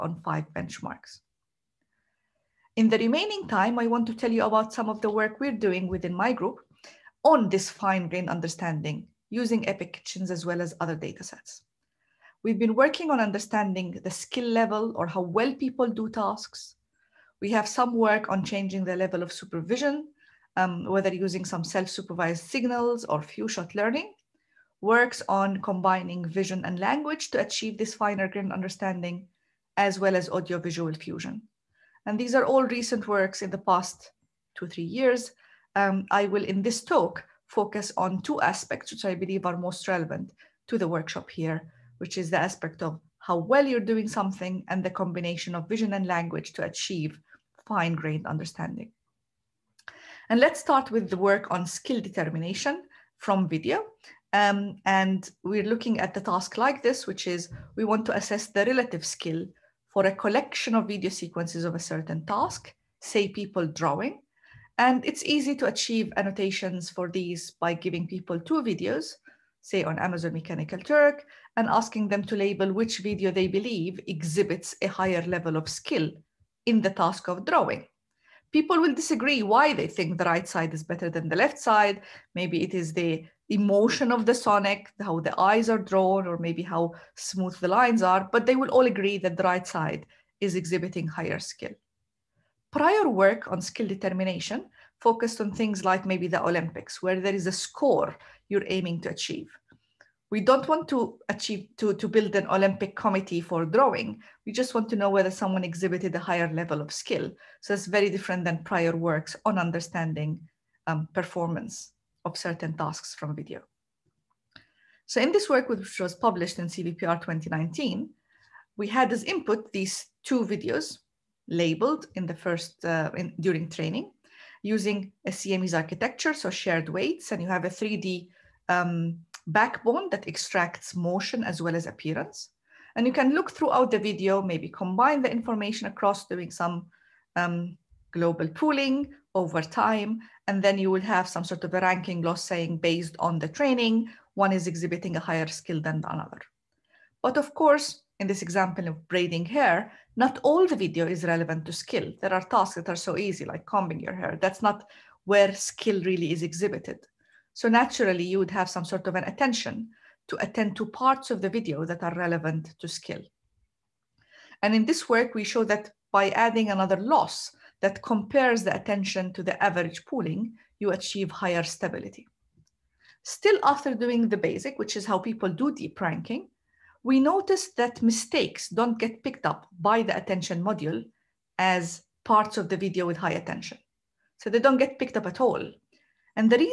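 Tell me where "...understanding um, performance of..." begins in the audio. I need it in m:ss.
1:49.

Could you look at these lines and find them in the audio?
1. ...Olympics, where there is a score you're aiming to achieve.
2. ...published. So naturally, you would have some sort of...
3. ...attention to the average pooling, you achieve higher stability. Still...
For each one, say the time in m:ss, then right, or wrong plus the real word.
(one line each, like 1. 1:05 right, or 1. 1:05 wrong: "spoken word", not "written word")
1. 1:36 right
2. 2:36 wrong: "exhibited", not "published"
3. 2:48 right.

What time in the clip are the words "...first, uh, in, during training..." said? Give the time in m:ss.
2:02.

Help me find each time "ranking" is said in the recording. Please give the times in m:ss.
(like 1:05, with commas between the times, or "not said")
2:21, 2:56.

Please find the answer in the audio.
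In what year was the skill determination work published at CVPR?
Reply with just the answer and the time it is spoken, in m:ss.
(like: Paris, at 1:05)
2019, at 1:57.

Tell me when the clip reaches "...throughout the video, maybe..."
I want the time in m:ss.
2:13.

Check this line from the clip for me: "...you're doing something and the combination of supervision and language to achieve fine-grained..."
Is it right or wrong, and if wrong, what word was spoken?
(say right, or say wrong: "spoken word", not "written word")
wrong: "vision", not "supervision".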